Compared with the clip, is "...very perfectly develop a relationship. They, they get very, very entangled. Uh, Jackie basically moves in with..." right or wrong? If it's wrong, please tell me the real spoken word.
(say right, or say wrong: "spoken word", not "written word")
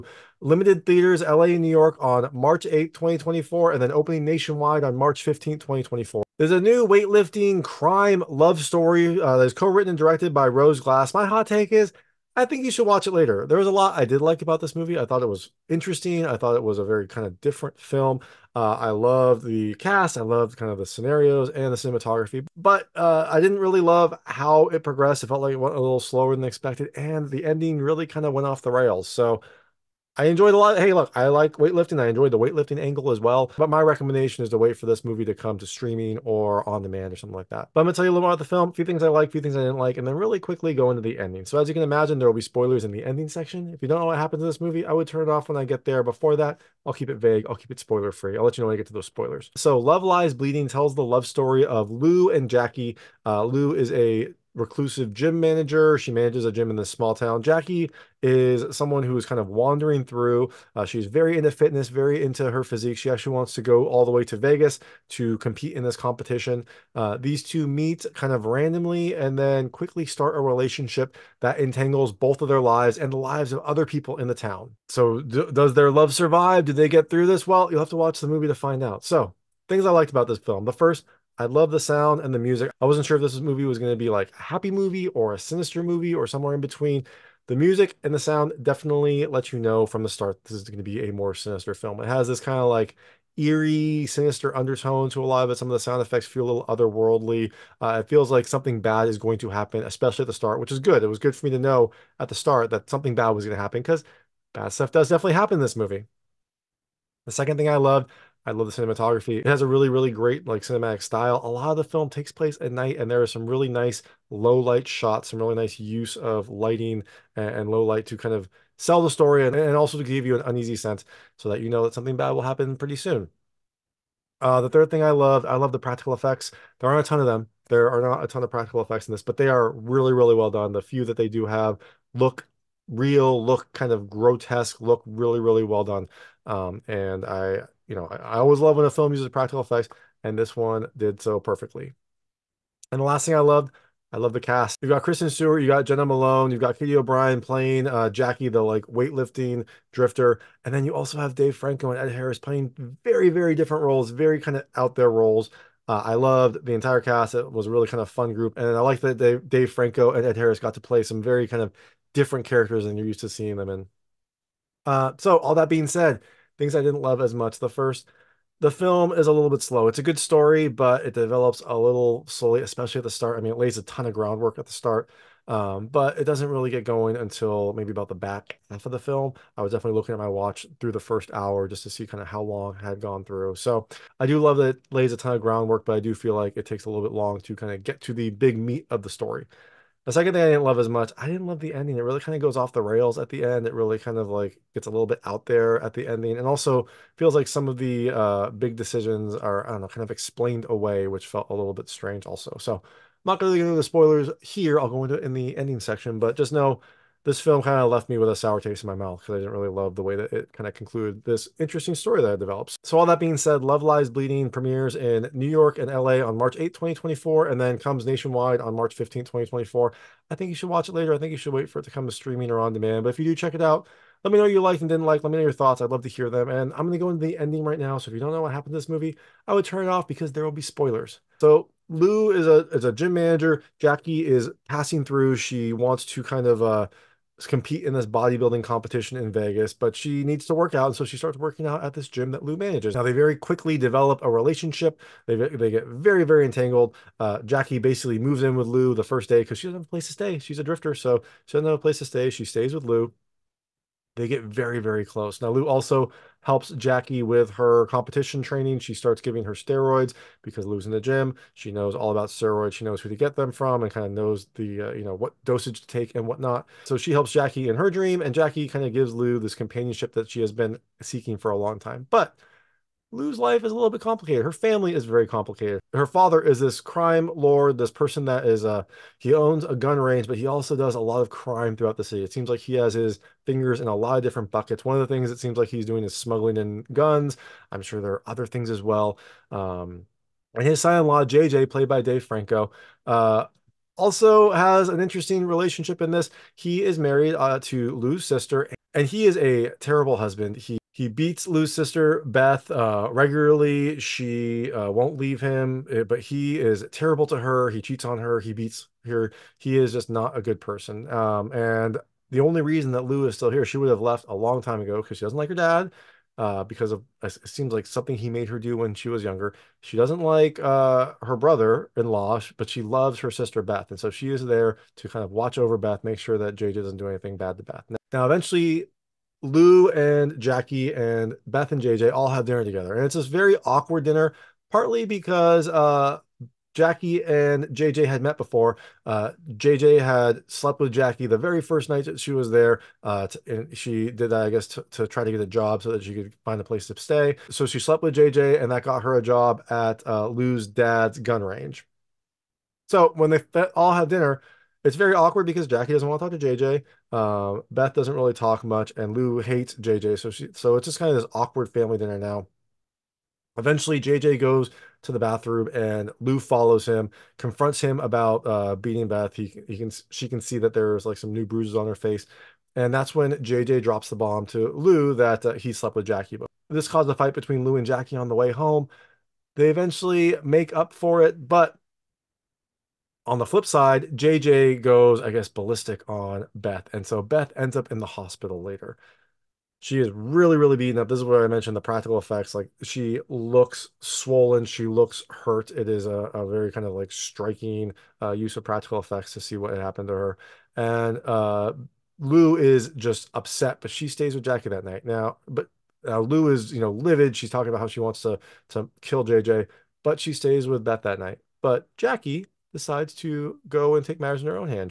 wrong: "quickly", not "perfectly".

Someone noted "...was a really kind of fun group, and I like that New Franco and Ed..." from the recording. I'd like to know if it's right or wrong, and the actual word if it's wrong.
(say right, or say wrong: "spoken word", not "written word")
wrong: "Dave", not "New".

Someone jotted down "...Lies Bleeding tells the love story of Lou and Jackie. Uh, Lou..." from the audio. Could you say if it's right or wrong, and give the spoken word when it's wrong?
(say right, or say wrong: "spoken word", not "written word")
right.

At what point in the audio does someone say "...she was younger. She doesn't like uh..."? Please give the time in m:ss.
5:18.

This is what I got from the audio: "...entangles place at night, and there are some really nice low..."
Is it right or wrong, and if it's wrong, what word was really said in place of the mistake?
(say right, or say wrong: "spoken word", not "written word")
wrong: "takes", not "entangles".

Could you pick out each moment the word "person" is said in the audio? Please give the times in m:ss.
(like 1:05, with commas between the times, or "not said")
4:37, 5:10.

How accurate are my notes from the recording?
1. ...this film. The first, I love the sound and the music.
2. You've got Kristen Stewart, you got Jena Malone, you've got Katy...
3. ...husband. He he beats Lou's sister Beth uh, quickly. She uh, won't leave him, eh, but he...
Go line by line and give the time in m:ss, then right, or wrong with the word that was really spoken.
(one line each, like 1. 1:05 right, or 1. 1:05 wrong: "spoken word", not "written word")
1. 1:20 right
2. 2:24 right
3. 5:00 wrong: "regularly", not "quickly".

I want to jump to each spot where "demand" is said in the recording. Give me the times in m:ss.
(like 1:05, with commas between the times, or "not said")
0:36, 3:42.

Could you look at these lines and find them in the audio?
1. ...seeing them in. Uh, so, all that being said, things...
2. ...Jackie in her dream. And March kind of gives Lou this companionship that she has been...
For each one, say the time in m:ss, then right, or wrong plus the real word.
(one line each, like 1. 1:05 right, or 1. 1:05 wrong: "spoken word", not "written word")
1. 2:43 right
2. 4:27 wrong: "Jackie", not "March".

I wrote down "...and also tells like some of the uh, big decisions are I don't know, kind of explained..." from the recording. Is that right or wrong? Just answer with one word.
wrong.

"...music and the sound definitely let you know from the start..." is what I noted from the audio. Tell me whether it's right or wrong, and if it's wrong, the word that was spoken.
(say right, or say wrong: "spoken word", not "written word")
right.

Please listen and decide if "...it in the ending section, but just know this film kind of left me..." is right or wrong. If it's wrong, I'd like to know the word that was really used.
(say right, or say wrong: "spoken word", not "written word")
right.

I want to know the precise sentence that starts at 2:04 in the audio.
Uh, the third thing I love, I love the practical effects.